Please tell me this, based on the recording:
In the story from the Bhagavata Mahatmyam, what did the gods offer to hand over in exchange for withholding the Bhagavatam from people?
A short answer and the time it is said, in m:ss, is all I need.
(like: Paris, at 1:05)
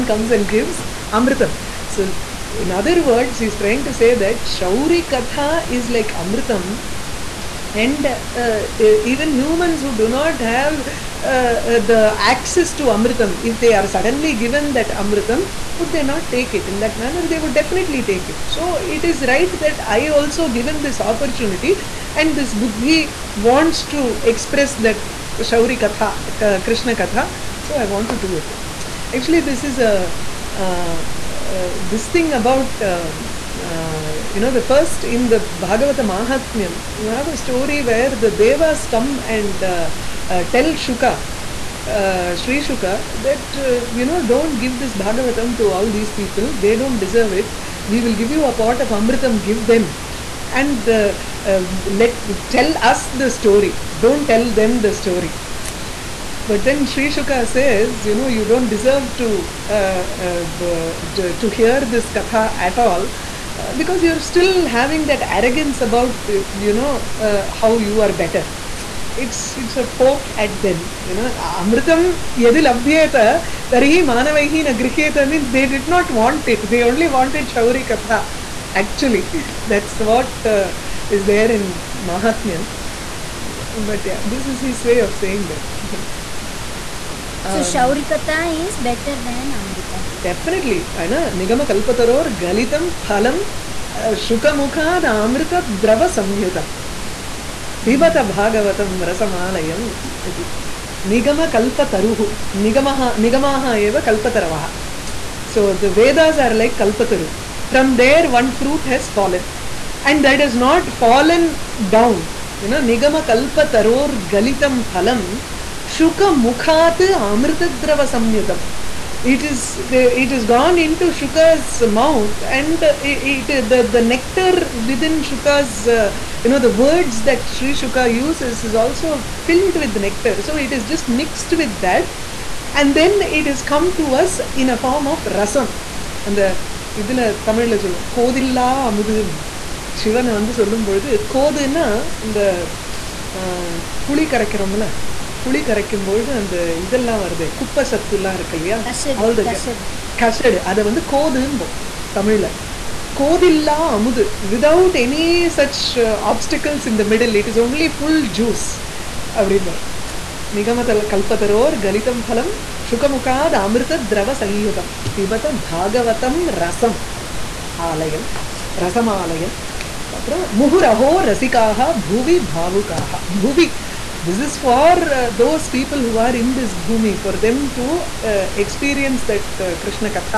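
A pot of Amritam, at 0:48.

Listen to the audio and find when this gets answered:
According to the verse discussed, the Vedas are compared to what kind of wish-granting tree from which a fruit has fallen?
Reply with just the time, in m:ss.
1:46.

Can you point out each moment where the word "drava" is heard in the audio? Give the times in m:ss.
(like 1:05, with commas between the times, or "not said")
1:35, 1:57.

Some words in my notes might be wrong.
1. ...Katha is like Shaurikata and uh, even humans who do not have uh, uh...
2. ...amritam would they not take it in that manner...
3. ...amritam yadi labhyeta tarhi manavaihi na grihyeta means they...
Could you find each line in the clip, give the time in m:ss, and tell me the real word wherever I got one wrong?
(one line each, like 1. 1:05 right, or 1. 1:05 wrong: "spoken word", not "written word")
1. 0:05 wrong: "Amritam", not "Shaurikata"
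2. 0:15 right
3. 1:11 right.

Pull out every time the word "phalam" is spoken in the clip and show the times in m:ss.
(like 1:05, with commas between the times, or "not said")
1:32, 1:54.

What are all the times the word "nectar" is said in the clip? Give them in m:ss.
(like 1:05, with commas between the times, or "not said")
2:04, 2:09.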